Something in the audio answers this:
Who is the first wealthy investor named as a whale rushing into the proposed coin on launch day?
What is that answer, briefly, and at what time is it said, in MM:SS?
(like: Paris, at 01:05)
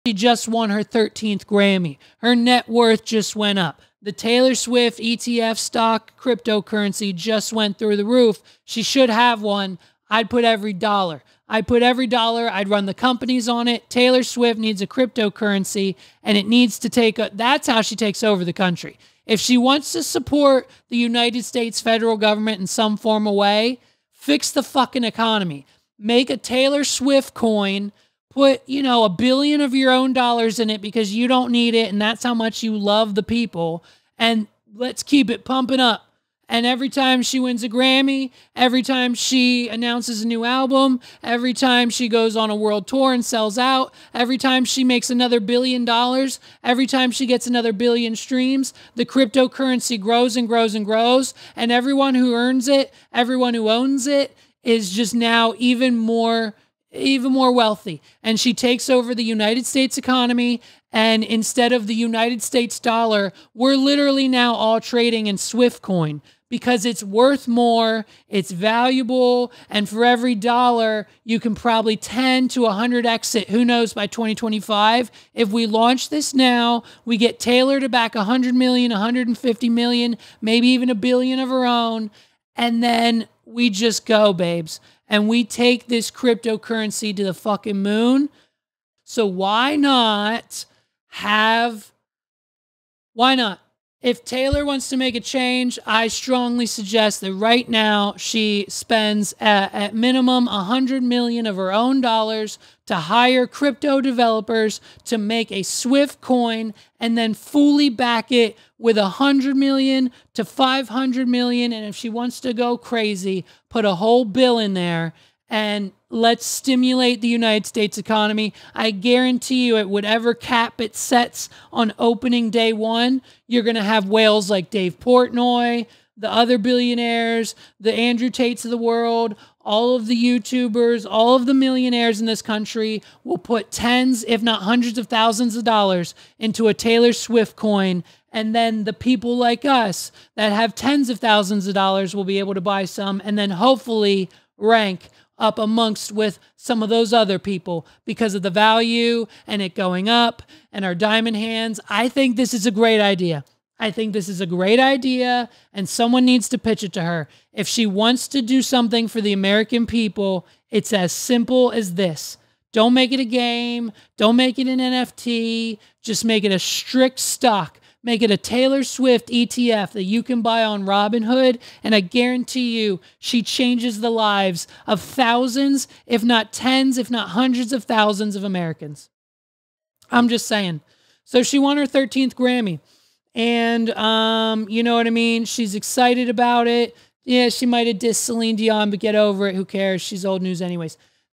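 Dave Portnoy, at 02:04.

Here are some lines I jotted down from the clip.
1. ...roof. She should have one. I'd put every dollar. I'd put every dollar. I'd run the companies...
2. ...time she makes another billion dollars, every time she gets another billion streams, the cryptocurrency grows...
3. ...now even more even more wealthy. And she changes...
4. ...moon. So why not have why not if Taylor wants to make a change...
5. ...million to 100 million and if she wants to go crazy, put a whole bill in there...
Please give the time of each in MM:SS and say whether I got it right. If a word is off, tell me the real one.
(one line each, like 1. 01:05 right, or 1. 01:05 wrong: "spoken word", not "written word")
1. 00:08 right
2. 00:44 right
3. 00:55 wrong: "takes", not "changes"
4. 01:27 right
5. 01:49 wrong: "500", not "100".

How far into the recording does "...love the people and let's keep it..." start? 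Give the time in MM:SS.
00:32.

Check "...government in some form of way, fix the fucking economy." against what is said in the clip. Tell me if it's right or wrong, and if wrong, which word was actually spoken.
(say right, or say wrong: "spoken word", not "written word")
right.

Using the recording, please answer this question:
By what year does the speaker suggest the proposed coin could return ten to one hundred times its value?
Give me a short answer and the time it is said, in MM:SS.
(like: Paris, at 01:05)
2025, at 01:14.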